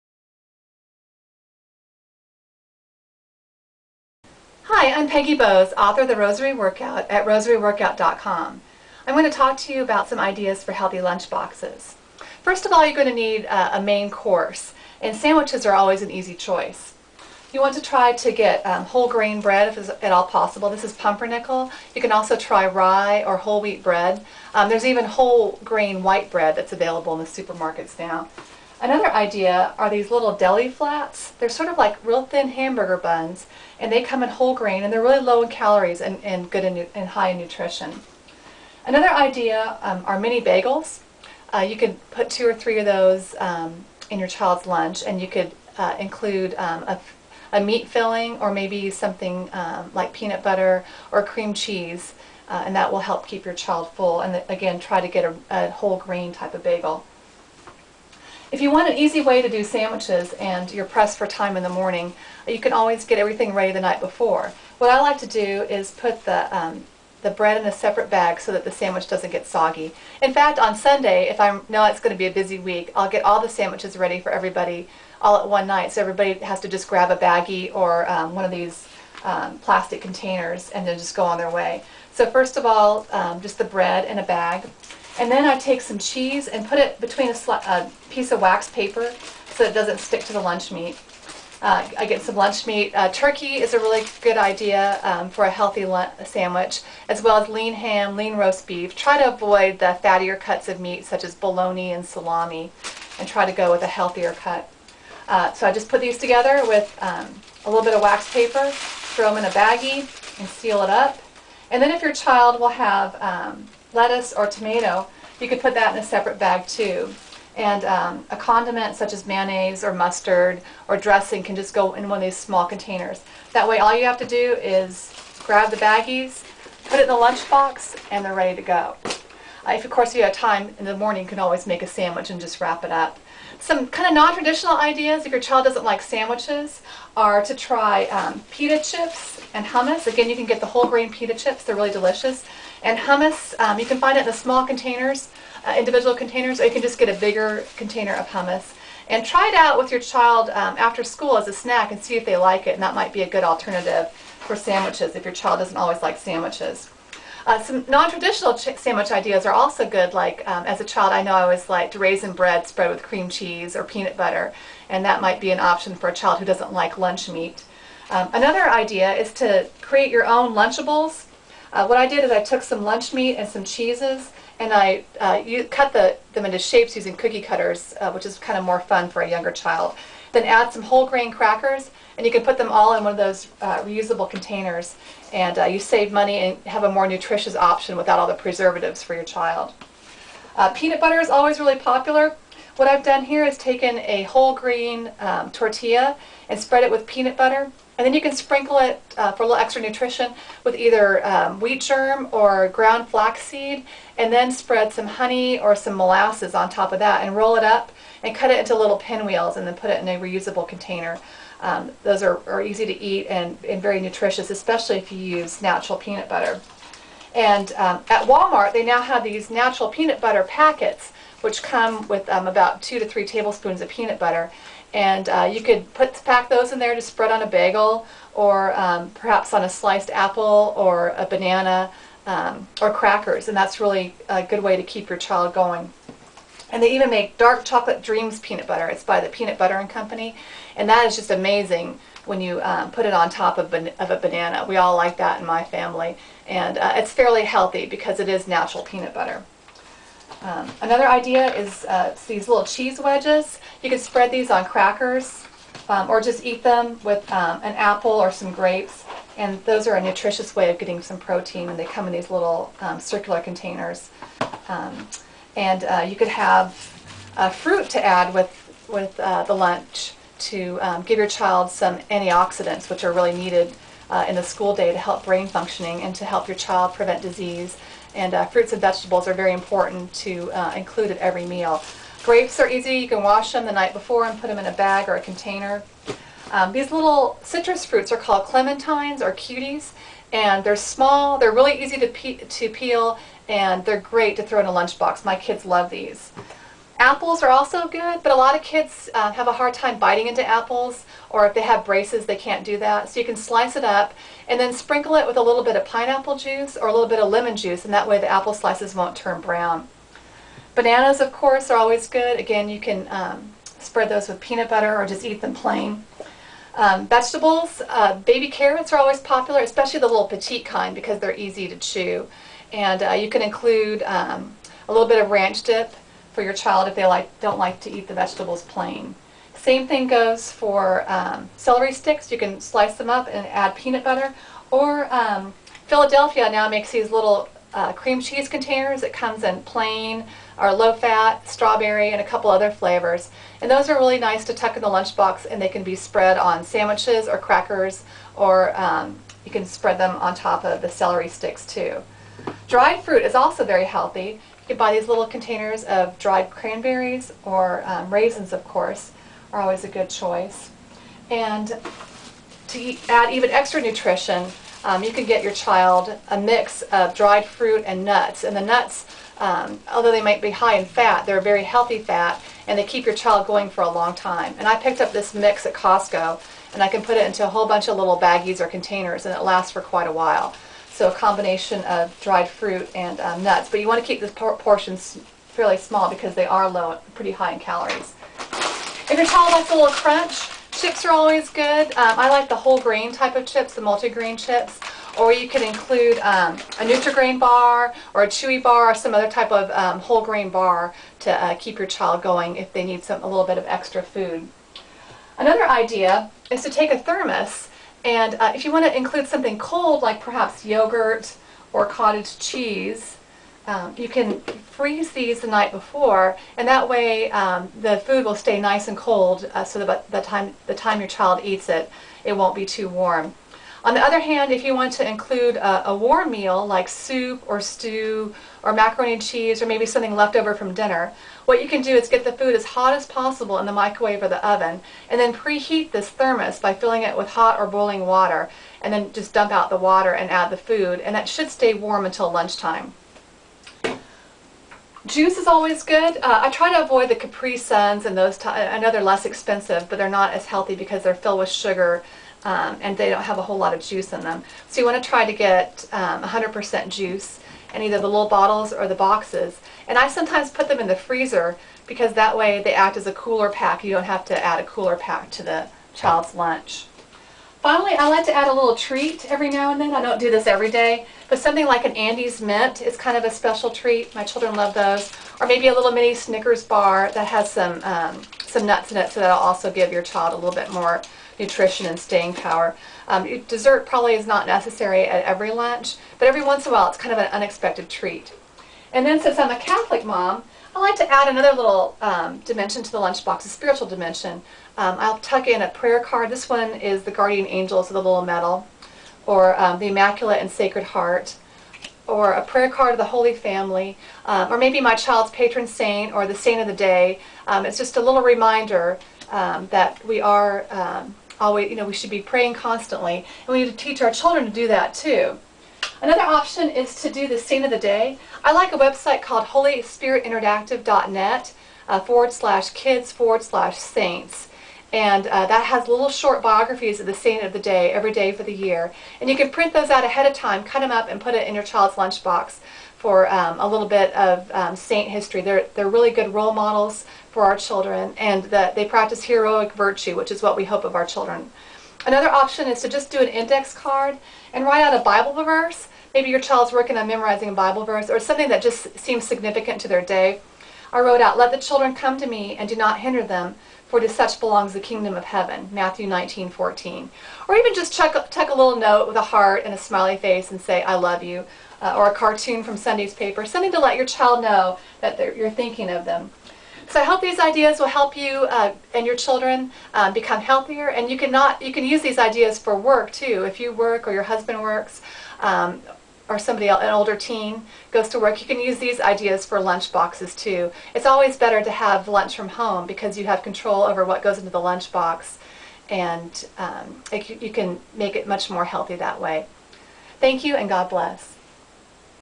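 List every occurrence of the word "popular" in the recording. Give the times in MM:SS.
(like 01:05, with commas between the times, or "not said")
03:11, 05:19.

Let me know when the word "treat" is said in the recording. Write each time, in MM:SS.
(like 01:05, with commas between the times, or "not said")
07:48, 07:53, 08:07.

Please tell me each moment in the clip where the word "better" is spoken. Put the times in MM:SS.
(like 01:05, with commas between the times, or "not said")
09:41.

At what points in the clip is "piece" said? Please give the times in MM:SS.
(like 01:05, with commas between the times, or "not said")
01:28.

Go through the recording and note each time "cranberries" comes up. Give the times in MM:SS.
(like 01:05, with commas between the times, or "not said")
05:56.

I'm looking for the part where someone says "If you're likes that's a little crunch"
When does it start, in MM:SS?
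06:29.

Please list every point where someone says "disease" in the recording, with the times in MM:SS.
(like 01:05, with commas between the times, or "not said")
04:37.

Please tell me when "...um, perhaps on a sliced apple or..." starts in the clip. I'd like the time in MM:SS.
03:48.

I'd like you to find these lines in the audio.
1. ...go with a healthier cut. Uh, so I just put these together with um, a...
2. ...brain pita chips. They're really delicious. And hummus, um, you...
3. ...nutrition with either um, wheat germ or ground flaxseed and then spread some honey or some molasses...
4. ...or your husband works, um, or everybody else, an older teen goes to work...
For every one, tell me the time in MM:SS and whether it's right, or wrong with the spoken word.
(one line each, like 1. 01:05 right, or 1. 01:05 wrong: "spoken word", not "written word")
1. 01:43 right
2. 02:20 wrong: "grain", not "brain"
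3. 03:19 right
4. 09:34 wrong: "somebody", not "everybody".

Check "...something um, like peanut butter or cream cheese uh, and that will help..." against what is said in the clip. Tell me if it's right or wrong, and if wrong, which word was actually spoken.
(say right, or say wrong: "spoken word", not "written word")
right.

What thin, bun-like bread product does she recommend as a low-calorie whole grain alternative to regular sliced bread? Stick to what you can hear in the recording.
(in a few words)
Deli flats.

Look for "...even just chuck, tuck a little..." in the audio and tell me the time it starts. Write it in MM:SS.
09:17.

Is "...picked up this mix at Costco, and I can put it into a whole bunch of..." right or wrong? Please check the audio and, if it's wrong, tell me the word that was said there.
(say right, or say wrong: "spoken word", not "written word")
right.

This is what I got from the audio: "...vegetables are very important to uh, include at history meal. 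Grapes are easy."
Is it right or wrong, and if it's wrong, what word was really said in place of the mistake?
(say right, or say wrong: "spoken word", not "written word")
wrong: "every", not "history".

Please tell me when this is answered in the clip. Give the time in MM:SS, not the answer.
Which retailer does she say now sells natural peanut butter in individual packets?
03:38.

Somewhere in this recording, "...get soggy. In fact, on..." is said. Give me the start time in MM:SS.
01:09.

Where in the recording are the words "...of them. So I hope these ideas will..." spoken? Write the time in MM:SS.
09:25.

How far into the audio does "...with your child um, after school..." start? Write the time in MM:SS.
02:29.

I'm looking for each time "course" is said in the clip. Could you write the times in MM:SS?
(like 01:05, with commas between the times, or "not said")
00:14, 02:09, 05:11, 05:58.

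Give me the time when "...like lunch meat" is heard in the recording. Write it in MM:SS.
02:46.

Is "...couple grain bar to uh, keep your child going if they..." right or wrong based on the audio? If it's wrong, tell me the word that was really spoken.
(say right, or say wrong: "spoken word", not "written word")
wrong: "whole", not "couple".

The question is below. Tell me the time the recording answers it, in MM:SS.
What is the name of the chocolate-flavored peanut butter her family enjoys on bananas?
03:57.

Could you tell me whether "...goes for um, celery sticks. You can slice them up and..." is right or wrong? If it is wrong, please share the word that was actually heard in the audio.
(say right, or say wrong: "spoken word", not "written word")
right.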